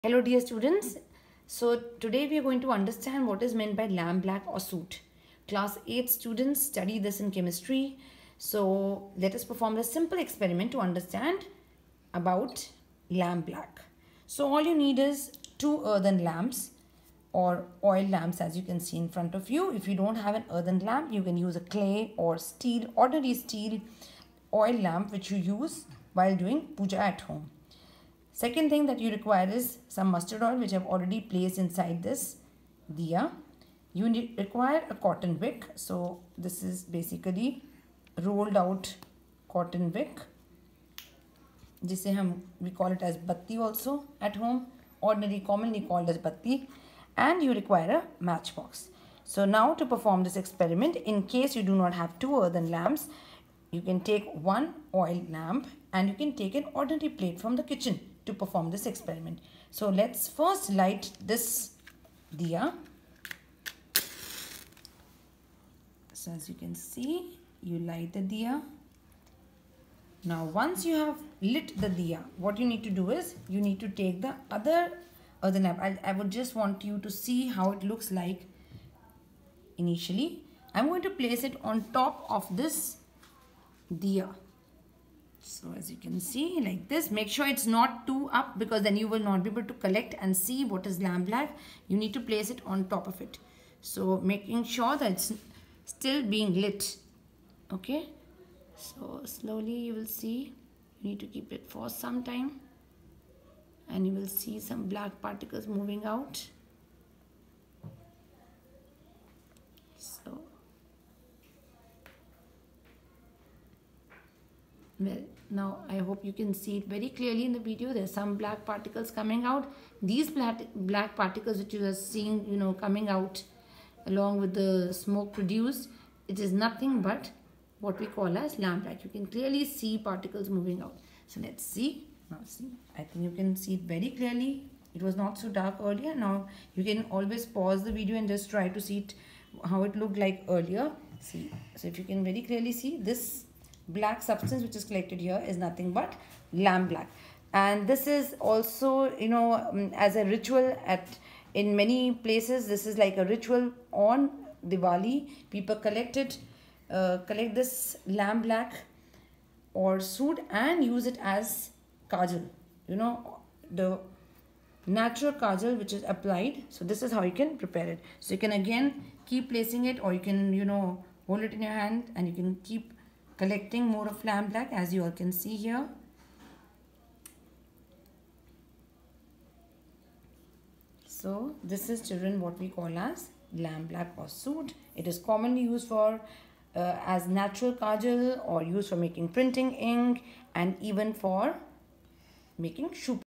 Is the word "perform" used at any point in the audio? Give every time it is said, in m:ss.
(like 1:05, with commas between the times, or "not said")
0:09, 0:49, 0:58.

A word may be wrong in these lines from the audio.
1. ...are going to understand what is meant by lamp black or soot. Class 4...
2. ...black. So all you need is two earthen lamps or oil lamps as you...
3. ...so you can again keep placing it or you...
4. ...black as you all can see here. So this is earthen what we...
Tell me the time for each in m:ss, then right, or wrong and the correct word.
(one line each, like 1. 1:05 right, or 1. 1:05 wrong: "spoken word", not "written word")
1. 0:02 wrong: "8", not "4"
2. 0:13 right
3. 2:48 right
4. 2:54 wrong: "children", not "earthen".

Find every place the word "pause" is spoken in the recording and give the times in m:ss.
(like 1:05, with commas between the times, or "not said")
2:17.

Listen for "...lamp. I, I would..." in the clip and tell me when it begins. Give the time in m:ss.
1:15.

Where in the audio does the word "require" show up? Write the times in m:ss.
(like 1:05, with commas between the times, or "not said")
0:29, 0:34, 0:47.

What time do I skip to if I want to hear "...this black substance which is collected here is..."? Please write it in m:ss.
2:23.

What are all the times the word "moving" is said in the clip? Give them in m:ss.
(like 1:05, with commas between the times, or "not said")
1:45, 2:10.